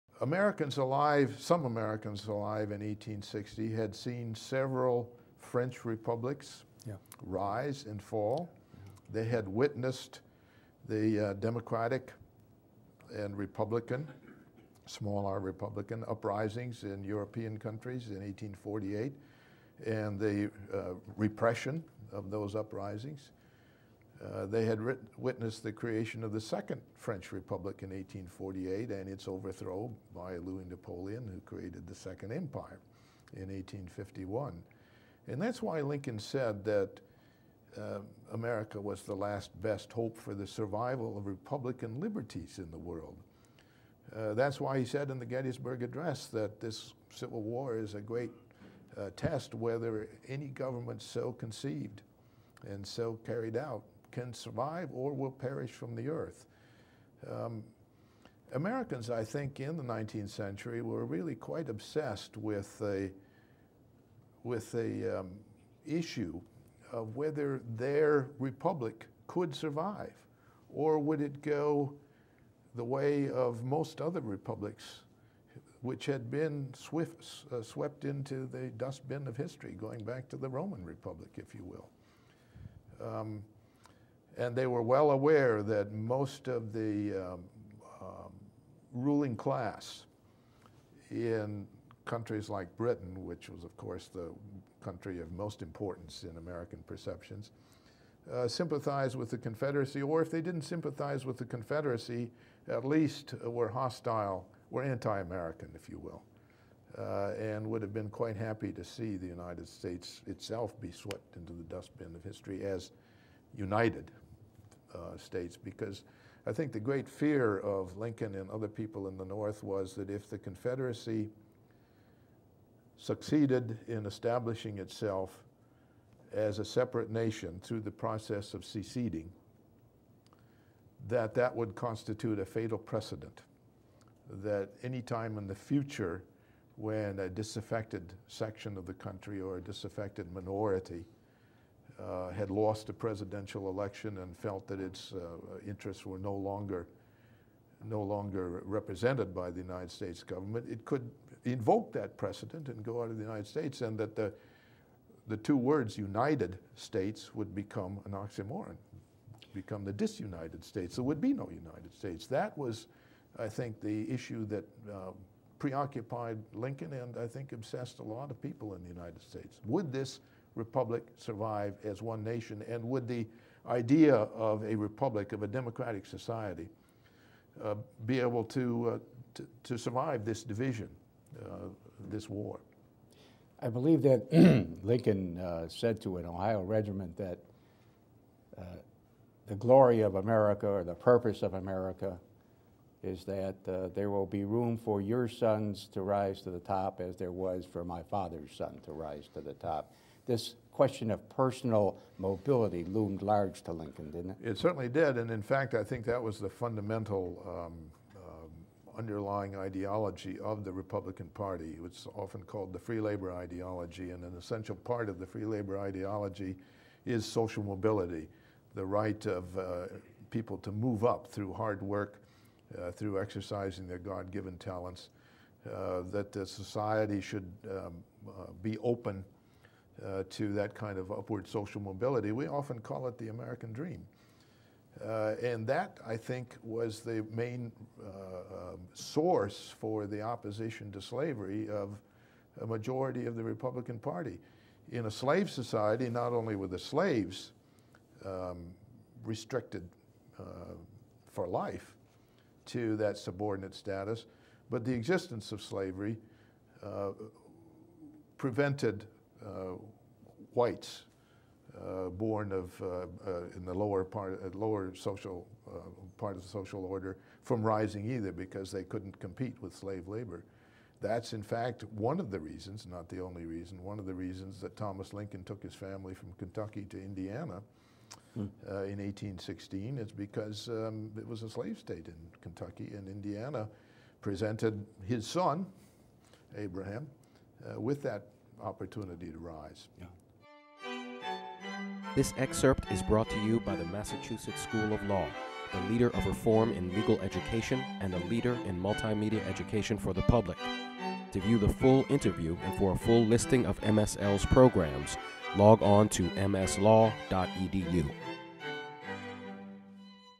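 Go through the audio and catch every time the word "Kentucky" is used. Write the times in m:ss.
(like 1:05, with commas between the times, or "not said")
4:36, 4:42.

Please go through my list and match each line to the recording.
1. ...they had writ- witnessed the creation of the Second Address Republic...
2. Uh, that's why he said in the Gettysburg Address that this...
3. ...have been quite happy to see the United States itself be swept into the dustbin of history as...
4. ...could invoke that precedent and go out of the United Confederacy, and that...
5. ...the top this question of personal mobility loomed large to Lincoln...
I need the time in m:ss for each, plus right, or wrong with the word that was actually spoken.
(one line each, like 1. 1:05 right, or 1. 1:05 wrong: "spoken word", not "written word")
1. 0:24 wrong: "French", not "Address"
2. 0:44 right
3. 1:47 right
4. 2:30 wrong: "States", not "Confederacy"
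5. 3:19 right.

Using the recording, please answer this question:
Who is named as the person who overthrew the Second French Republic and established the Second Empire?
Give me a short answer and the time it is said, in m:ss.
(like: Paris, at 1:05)
Louis Napoleon, at 0:30.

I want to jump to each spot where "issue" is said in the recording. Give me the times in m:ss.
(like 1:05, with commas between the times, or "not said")
1:05, 2:44.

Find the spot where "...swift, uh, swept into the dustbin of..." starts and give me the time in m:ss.
1:16.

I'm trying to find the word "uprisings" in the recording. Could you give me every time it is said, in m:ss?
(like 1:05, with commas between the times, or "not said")
0:16, 0:22.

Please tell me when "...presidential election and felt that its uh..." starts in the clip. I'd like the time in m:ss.
2:22.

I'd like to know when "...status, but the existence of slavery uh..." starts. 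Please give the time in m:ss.
4:13.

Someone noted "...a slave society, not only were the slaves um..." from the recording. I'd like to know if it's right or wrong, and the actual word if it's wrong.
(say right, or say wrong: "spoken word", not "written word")
right.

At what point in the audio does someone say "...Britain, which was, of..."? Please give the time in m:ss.
1:32.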